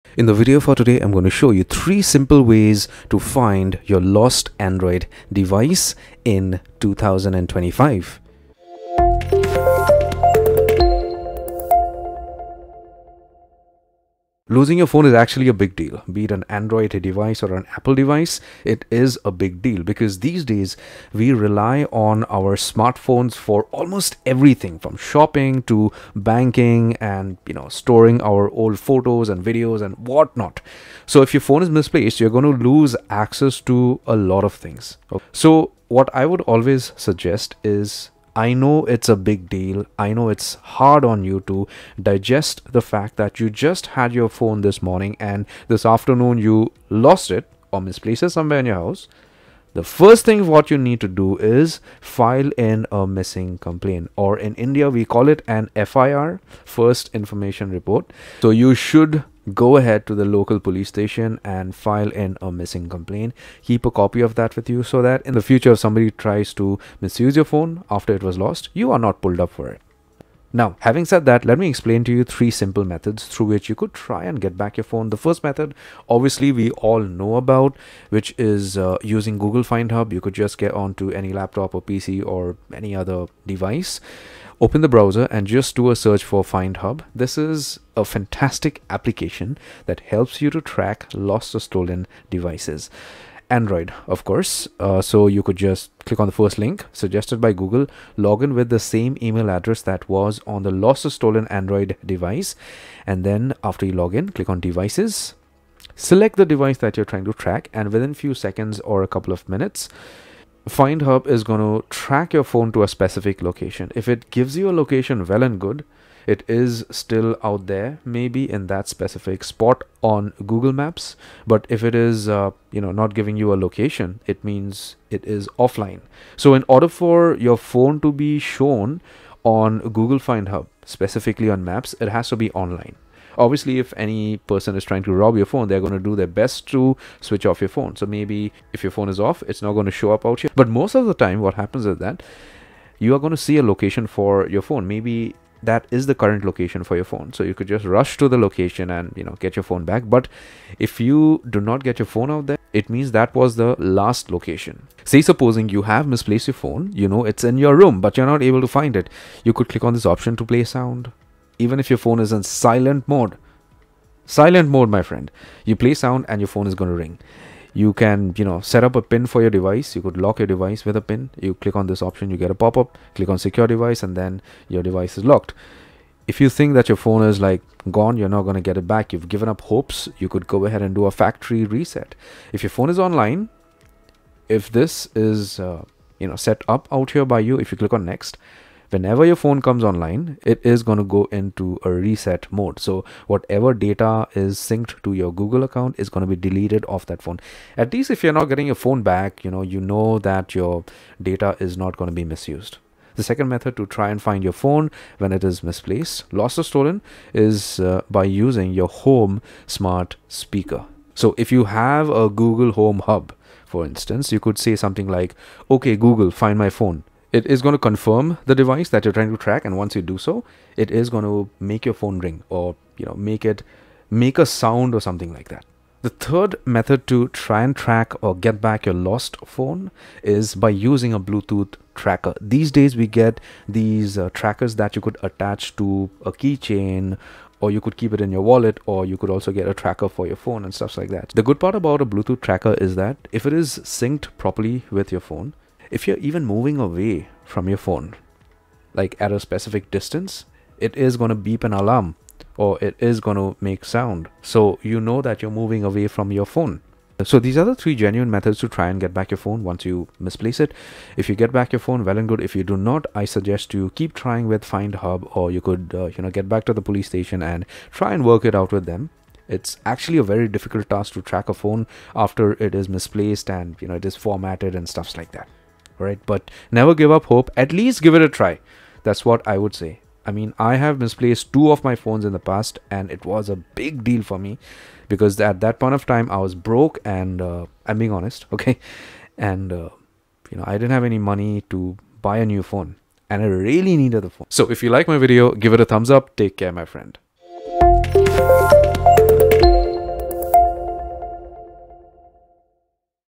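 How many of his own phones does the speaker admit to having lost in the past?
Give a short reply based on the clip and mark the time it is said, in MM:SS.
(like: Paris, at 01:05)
2, at 04:41.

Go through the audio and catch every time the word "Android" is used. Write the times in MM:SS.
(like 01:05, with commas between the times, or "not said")
00:04, 00:16, 01:33, 01:41.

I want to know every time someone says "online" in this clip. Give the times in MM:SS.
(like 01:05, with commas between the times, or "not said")
02:12, 03:02, 03:09.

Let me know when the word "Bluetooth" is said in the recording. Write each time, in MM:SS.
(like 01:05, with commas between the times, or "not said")
03:51, 04:02.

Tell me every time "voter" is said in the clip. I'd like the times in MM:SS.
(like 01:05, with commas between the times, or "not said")
not said.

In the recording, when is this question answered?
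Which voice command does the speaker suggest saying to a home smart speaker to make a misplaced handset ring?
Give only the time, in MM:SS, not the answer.
03:35.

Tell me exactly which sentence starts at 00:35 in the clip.
So what I would always suggest is I know it's a big deal.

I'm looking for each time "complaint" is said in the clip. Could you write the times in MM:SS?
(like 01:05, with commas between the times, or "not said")
00:53, 01:02.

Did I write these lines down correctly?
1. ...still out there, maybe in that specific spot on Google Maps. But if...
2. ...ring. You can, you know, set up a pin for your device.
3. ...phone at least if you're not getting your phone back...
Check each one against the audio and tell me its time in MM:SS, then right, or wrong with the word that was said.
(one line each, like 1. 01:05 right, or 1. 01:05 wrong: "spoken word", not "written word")
1. 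01:56 right
2. 02:46 right
3. 03:17 right.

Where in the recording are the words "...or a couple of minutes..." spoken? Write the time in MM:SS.
01:48.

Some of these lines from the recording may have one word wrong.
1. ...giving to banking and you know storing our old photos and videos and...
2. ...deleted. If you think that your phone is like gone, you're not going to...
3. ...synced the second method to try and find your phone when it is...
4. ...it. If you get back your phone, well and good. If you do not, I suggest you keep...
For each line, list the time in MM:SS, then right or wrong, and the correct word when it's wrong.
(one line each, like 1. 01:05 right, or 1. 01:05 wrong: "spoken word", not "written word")
1. 00:24 wrong: "shopping", not "giving"
2. 02:55 wrong: "locked", not "deleted"
3. 03:22 wrong: "misused", not "synced"
4. 04:20 right.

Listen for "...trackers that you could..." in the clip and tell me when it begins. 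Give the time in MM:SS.
03:54.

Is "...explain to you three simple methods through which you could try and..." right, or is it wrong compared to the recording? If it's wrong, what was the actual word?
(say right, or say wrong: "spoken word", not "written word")
right.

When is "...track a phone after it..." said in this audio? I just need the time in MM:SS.
04:31.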